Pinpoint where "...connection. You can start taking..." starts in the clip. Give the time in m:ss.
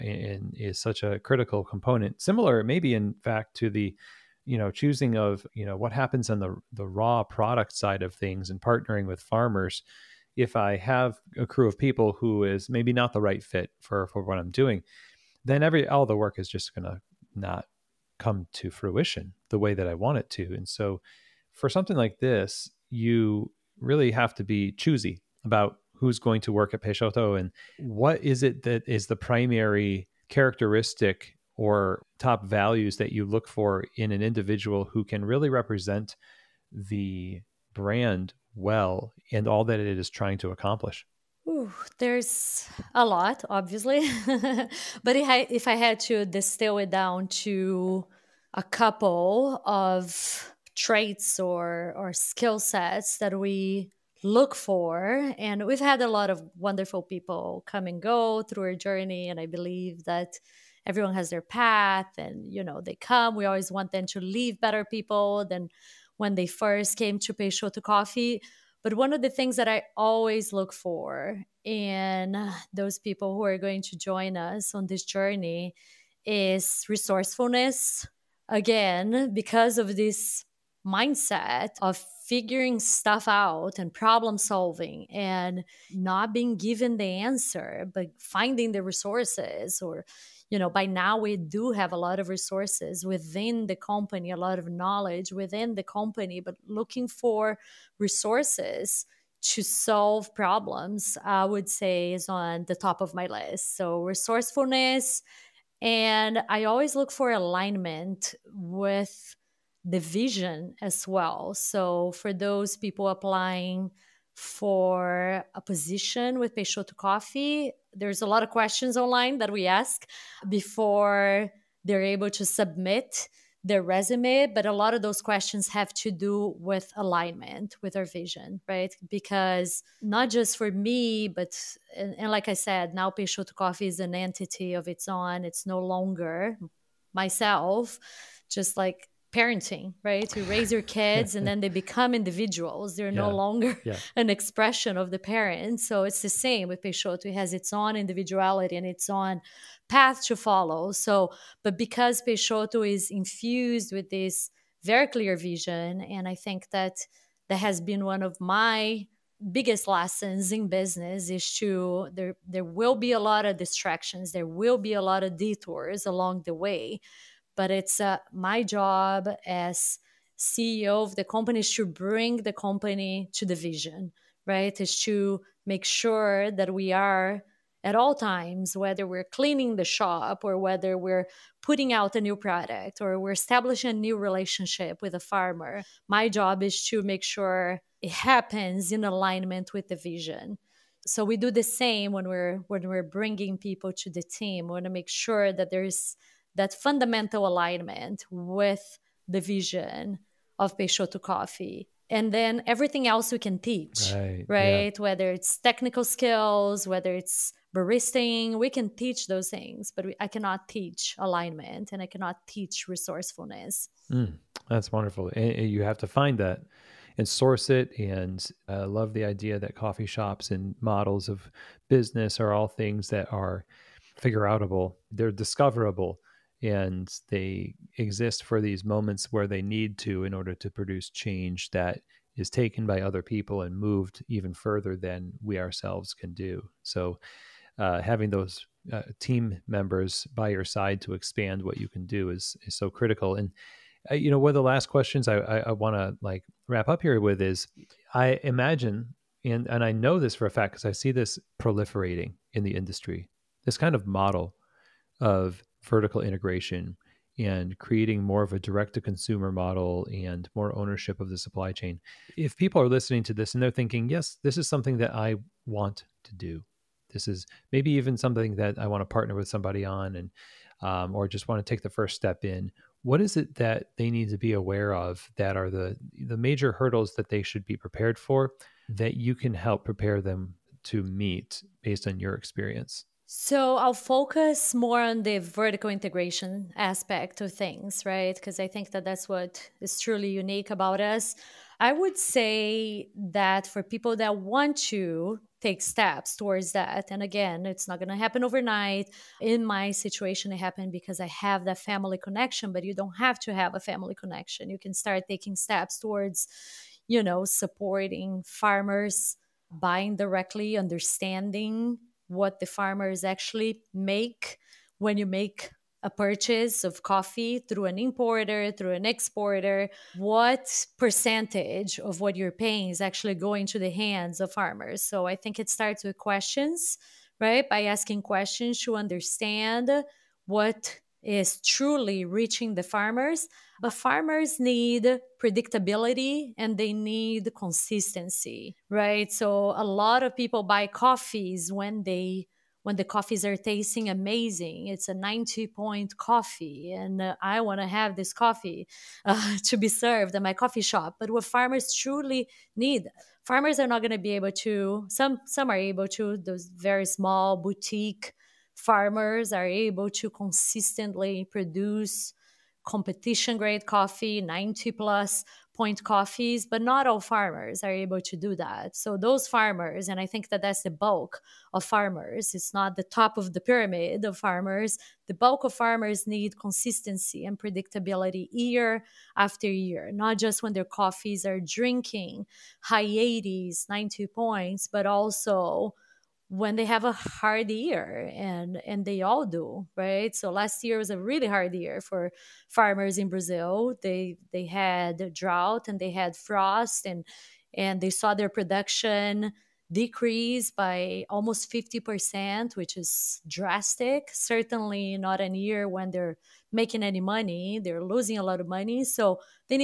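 5:04.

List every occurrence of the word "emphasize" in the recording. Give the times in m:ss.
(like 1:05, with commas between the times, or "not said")
not said.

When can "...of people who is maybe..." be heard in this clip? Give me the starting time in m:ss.
0:11.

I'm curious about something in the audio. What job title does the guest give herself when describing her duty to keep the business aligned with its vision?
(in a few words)
CEO.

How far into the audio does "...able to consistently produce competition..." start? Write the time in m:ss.
5:59.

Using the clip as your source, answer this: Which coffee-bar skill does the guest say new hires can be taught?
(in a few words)
Baristing.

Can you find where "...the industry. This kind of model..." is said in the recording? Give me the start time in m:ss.
4:12.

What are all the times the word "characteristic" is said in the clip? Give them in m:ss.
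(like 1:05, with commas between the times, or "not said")
0:30.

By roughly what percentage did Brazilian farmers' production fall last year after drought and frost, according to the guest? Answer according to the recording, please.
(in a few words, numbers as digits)
50%.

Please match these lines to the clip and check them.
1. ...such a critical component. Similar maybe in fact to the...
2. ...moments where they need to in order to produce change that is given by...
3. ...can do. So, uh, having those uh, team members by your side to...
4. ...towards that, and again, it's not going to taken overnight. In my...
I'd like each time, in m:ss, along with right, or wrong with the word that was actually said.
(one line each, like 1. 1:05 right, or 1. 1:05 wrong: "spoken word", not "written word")
1. 0:00 right
2. 3:48 wrong: "taken", not "given"
3. 3:56 right
4. 4:56 wrong: "happen", not "taken".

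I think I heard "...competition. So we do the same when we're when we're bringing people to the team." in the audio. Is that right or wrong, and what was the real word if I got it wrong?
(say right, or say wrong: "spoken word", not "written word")
wrong: "vision", not "competition".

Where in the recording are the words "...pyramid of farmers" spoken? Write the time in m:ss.
6:13.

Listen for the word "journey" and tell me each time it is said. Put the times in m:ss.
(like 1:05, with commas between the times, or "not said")
0:58, 1:15.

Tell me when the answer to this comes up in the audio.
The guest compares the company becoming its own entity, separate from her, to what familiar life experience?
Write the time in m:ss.
2:19.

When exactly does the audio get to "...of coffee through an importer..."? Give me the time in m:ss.
5:16.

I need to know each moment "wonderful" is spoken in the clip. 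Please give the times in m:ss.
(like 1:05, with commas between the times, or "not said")
0:56, 3:34.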